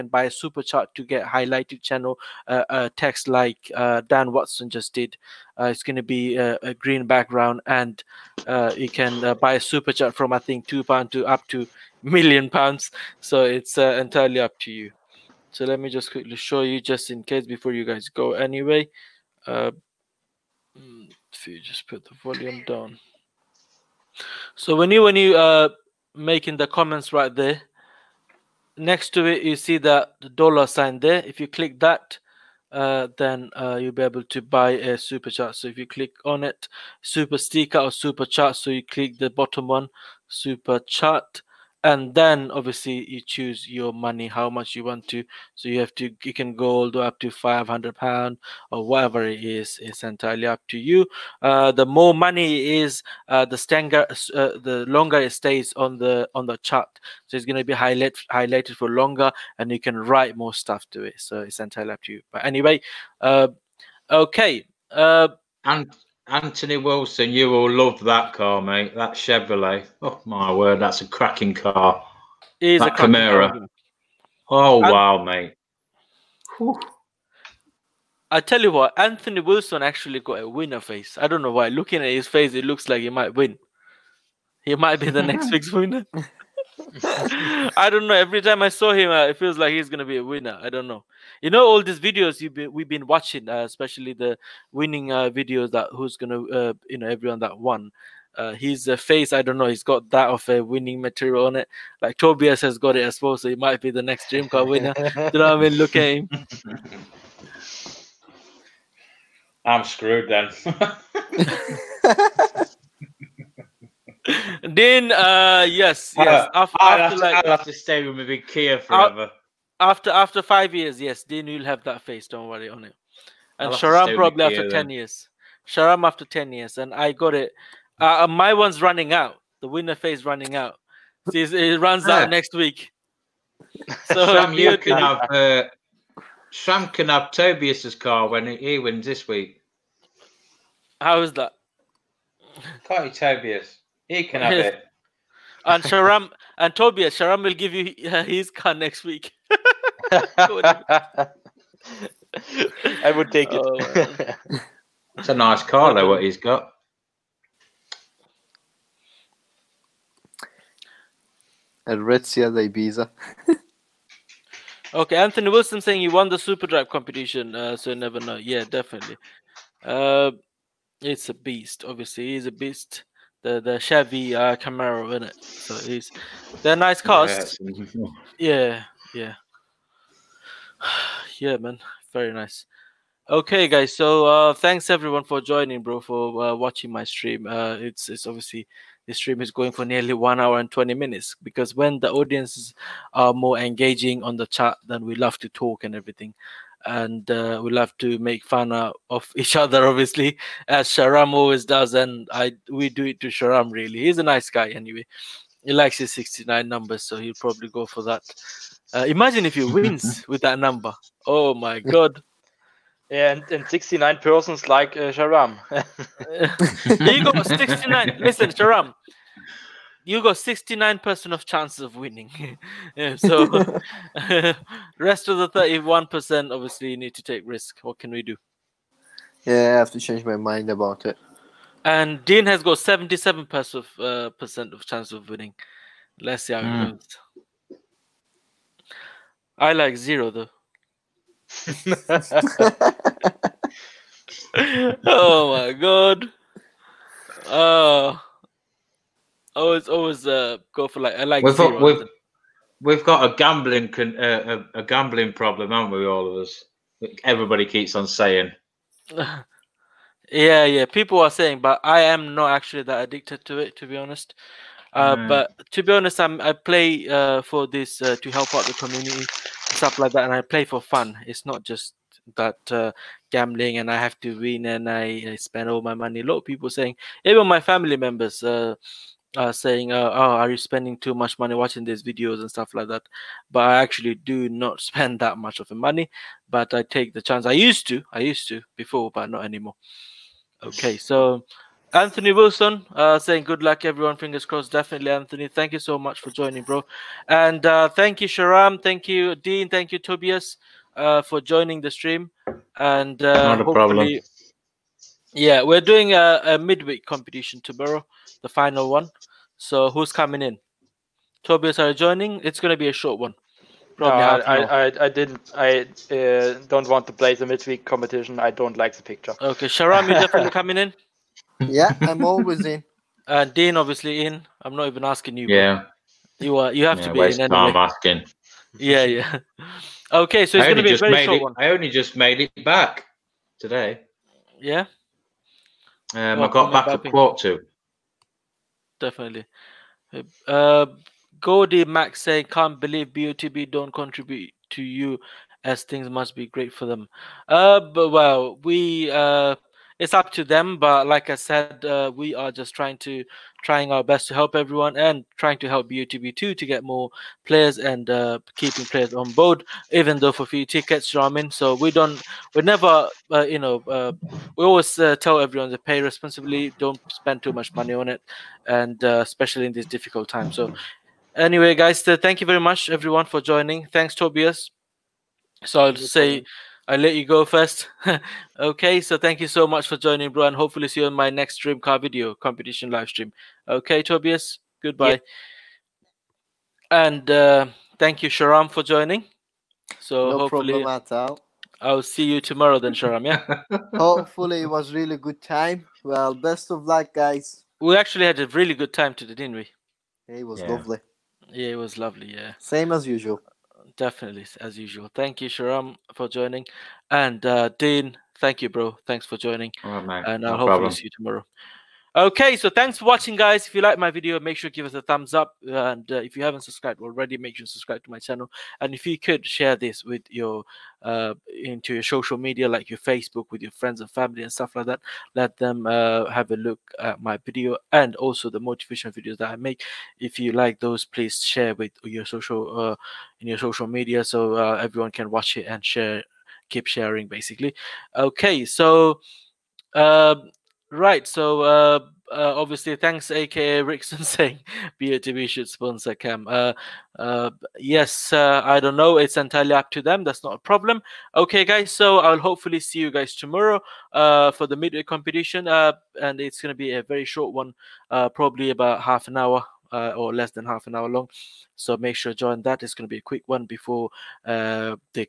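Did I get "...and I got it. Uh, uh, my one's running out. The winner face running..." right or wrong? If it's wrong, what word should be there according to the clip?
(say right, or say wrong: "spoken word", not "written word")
right.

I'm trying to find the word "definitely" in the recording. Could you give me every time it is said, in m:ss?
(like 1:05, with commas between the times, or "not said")
2:48, 4:54, 5:20, 5:38, 6:43.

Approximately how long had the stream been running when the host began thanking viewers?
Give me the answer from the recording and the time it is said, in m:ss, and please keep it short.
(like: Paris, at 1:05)
1 hour 20 minutes, at 3:10.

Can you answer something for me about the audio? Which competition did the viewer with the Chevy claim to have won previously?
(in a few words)
Super Drive competition.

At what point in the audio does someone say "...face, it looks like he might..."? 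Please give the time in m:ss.
1:22.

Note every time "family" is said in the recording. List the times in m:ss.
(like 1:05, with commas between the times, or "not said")
4:37, 7:04.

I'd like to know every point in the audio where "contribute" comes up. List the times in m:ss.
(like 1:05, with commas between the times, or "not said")
5:43.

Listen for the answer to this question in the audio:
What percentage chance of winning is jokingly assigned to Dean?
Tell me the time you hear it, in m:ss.
3:52.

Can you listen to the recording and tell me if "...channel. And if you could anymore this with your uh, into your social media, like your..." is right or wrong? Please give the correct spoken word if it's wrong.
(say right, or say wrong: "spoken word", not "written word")
wrong: "share", not "anymore".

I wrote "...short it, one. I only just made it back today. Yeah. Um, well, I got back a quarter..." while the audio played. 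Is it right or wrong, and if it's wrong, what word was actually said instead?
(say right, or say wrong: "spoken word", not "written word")
right.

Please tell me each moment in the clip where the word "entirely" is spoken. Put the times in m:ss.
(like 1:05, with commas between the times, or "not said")
0:13, 0:50, 1:01, 7:29.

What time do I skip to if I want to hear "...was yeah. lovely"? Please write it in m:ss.
6:40.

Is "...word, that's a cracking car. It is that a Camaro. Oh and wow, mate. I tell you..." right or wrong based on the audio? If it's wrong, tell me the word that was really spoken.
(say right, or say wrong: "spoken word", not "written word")
right.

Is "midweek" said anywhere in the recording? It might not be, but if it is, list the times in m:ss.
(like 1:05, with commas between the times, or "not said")
5:06, 5:17, 7:34.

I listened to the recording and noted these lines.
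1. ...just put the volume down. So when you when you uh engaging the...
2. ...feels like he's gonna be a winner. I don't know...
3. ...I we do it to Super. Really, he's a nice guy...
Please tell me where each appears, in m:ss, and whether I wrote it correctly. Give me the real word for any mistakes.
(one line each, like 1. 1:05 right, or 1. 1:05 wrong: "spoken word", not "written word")
1. 0:21 wrong: "making", not "engaging"
2. 1:29 right
3. 3:22 wrong: "Sharam", not "Super".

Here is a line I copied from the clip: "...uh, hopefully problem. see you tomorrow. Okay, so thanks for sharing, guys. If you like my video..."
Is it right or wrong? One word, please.
wrong.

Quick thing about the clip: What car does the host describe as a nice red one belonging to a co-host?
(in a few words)
Sierra Ibiza.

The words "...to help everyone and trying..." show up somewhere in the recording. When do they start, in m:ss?
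5:54.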